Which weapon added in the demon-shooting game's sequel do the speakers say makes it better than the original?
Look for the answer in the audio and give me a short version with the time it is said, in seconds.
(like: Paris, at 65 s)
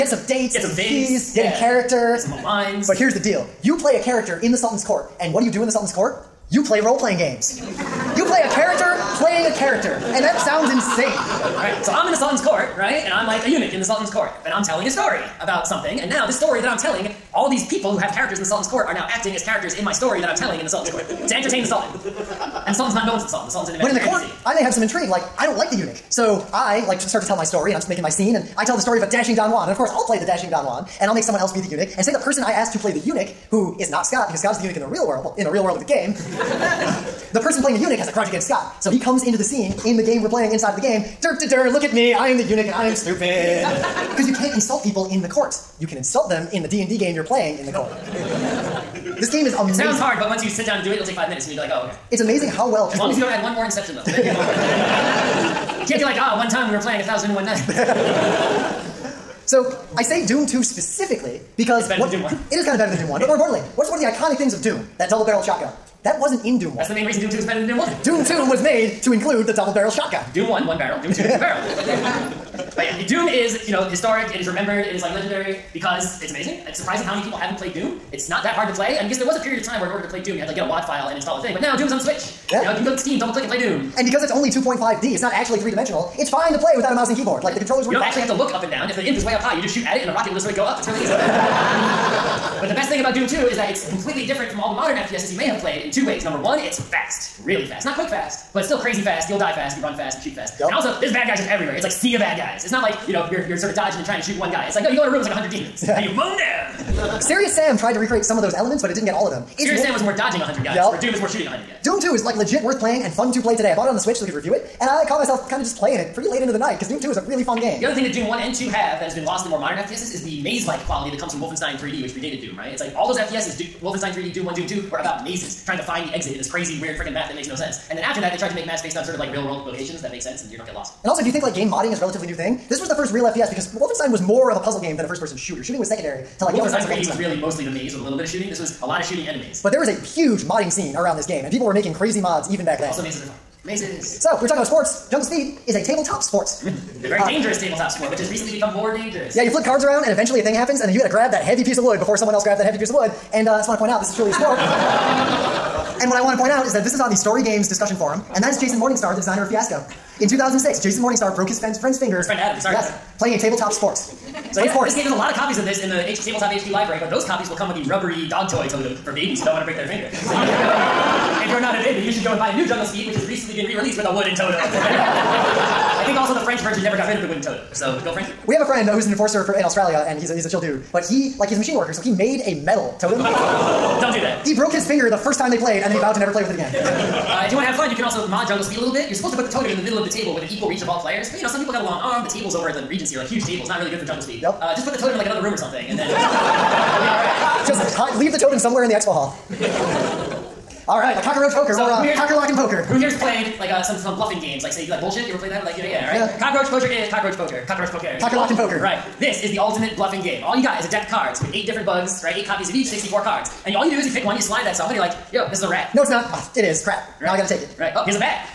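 double-barreled shotgun, at 65 s.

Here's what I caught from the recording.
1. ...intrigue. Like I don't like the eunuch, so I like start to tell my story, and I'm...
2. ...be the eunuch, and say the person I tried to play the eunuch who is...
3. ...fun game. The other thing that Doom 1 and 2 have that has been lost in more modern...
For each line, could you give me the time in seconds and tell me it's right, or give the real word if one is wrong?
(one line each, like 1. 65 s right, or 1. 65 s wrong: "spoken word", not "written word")
1. 24 s right
2. 31 s wrong: "asked", not "tried"
3. 117 s right.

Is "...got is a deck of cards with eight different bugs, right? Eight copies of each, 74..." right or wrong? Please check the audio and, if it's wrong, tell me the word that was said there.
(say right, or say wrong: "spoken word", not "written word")
wrong: "64", not "74".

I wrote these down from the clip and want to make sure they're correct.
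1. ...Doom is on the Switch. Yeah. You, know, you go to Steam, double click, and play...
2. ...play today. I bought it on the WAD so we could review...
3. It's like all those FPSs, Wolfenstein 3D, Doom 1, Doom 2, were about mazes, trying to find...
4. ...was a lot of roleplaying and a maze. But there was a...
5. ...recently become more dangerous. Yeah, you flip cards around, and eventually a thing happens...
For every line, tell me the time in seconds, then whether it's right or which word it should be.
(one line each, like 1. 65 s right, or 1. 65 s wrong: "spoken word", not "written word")
1. 81 s right
2. 113 s wrong: "Switch", not "WAD"
3. 122 s right
4. 138 s wrong: "shooting", not "roleplaying"
5. 148 s right.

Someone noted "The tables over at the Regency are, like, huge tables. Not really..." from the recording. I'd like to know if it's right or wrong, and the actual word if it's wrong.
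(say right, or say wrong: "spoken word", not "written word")
right.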